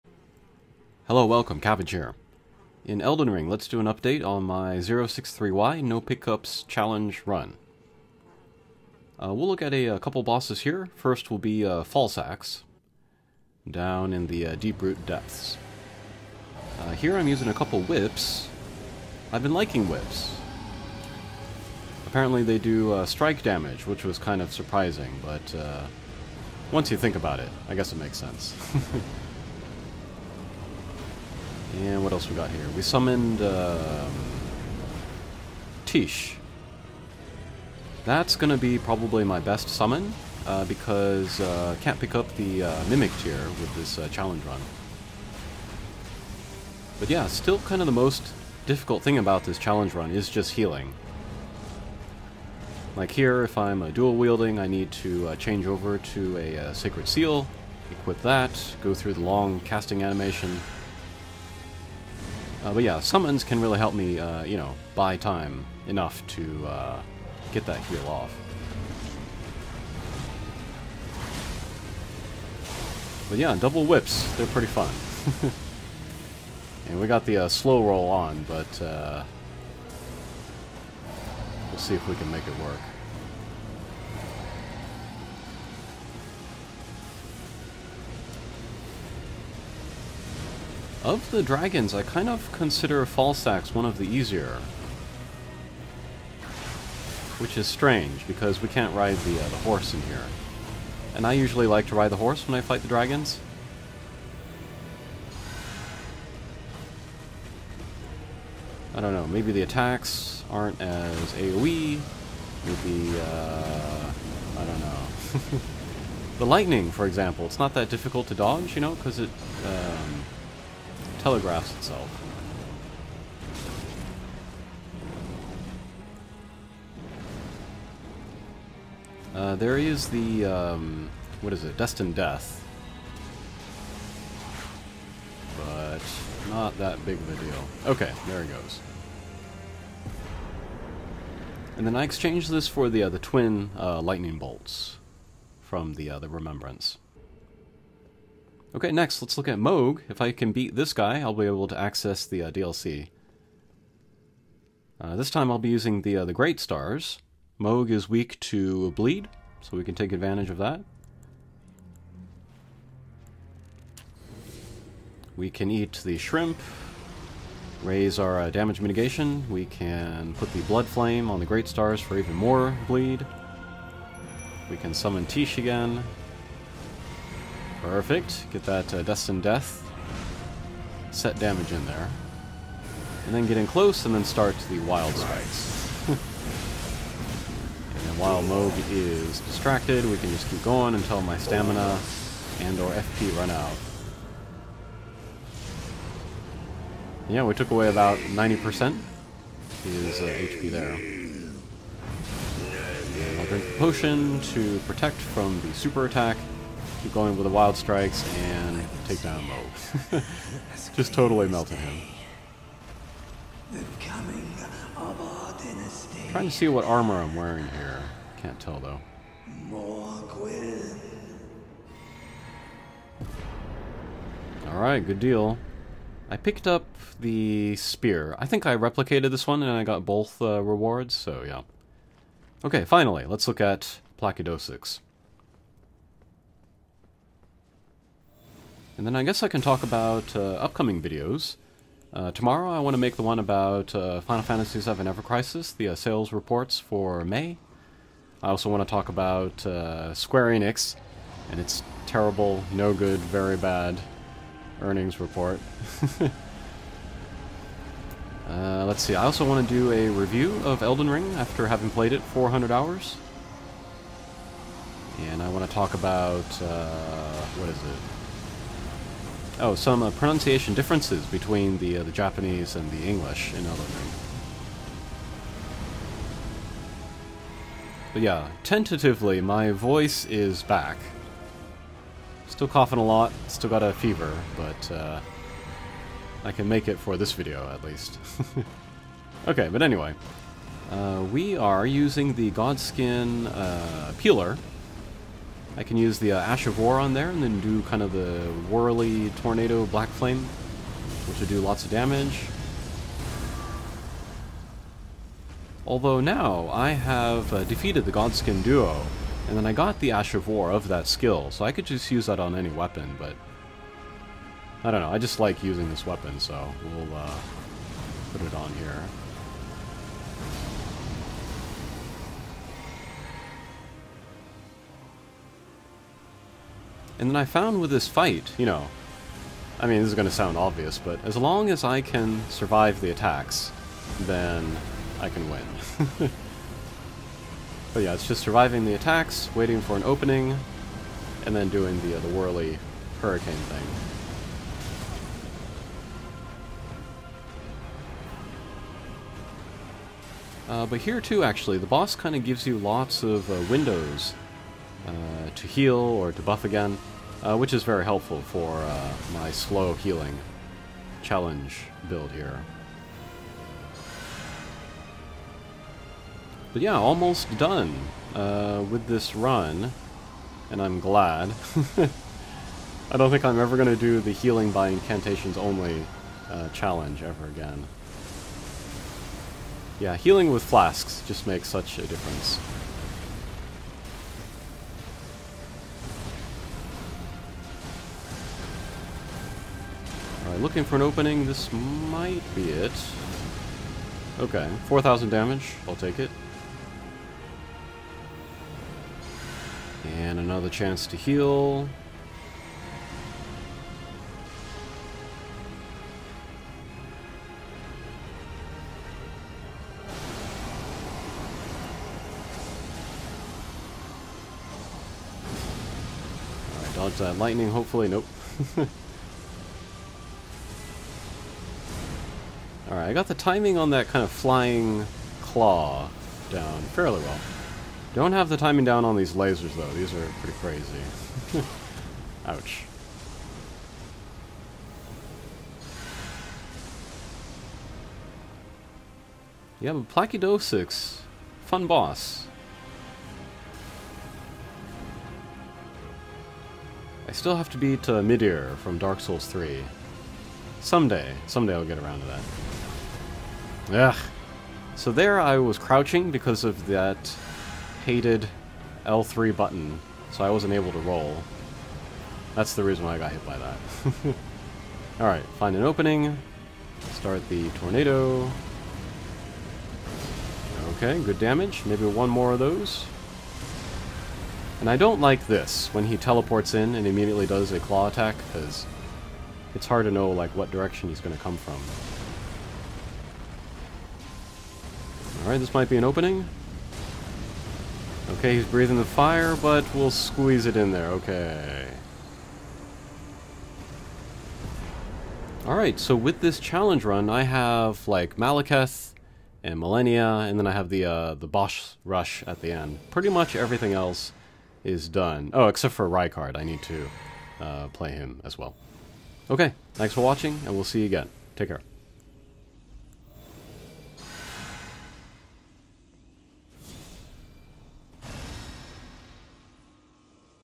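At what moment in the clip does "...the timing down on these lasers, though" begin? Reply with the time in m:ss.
7:08.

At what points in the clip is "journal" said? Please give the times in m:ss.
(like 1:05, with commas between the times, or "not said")
not said.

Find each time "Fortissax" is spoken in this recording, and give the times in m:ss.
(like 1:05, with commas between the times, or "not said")
0:11, 1:33.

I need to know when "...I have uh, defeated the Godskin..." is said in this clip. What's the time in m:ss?
5:06.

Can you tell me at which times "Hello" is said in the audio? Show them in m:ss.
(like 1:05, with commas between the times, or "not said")
0:01.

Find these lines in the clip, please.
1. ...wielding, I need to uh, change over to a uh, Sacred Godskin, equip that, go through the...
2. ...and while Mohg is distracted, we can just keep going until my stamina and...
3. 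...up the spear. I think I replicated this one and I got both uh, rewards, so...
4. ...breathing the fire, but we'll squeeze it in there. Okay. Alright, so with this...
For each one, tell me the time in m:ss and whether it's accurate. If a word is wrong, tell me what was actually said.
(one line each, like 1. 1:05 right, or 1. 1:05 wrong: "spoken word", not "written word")
1. 0:54 wrong: "Seal", not "Godskin"
2. 3:06 right
3. 3:46 right
4. 8:08 right.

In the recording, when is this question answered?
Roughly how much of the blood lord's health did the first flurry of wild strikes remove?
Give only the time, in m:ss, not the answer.
3:18.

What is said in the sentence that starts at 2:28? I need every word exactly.
Okay, next, let's look at Mohg.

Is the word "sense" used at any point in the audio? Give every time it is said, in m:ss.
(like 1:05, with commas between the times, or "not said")
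0:28.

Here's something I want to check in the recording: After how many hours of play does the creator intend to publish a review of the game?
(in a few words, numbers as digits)
400.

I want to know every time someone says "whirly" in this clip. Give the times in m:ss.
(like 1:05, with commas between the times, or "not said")
4:58, 5:42.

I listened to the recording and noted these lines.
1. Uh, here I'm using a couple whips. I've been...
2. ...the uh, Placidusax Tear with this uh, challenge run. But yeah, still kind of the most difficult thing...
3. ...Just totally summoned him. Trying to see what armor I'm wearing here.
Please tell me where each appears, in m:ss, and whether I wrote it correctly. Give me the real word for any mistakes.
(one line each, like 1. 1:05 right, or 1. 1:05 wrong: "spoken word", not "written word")
1. 0:16 right
2. 0:42 wrong: "Mimic", not "Placidusax"
3. 3:30 wrong: "melted", not "summoned".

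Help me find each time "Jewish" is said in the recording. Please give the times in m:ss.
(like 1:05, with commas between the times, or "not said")
not said.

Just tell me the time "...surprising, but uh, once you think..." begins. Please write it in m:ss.
0:24.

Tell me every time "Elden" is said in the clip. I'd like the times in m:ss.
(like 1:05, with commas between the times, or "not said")
0:03, 4:20, 4:33.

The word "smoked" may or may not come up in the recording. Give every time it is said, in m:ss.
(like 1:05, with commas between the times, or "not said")
not said.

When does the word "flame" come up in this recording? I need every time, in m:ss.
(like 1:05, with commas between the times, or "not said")
2:50, 5:00.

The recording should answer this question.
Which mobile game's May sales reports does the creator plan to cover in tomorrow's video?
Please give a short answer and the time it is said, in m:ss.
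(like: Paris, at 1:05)
Final Fantasy VII Ever Crisis, at 4:04.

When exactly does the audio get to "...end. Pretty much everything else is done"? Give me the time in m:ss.
8:22.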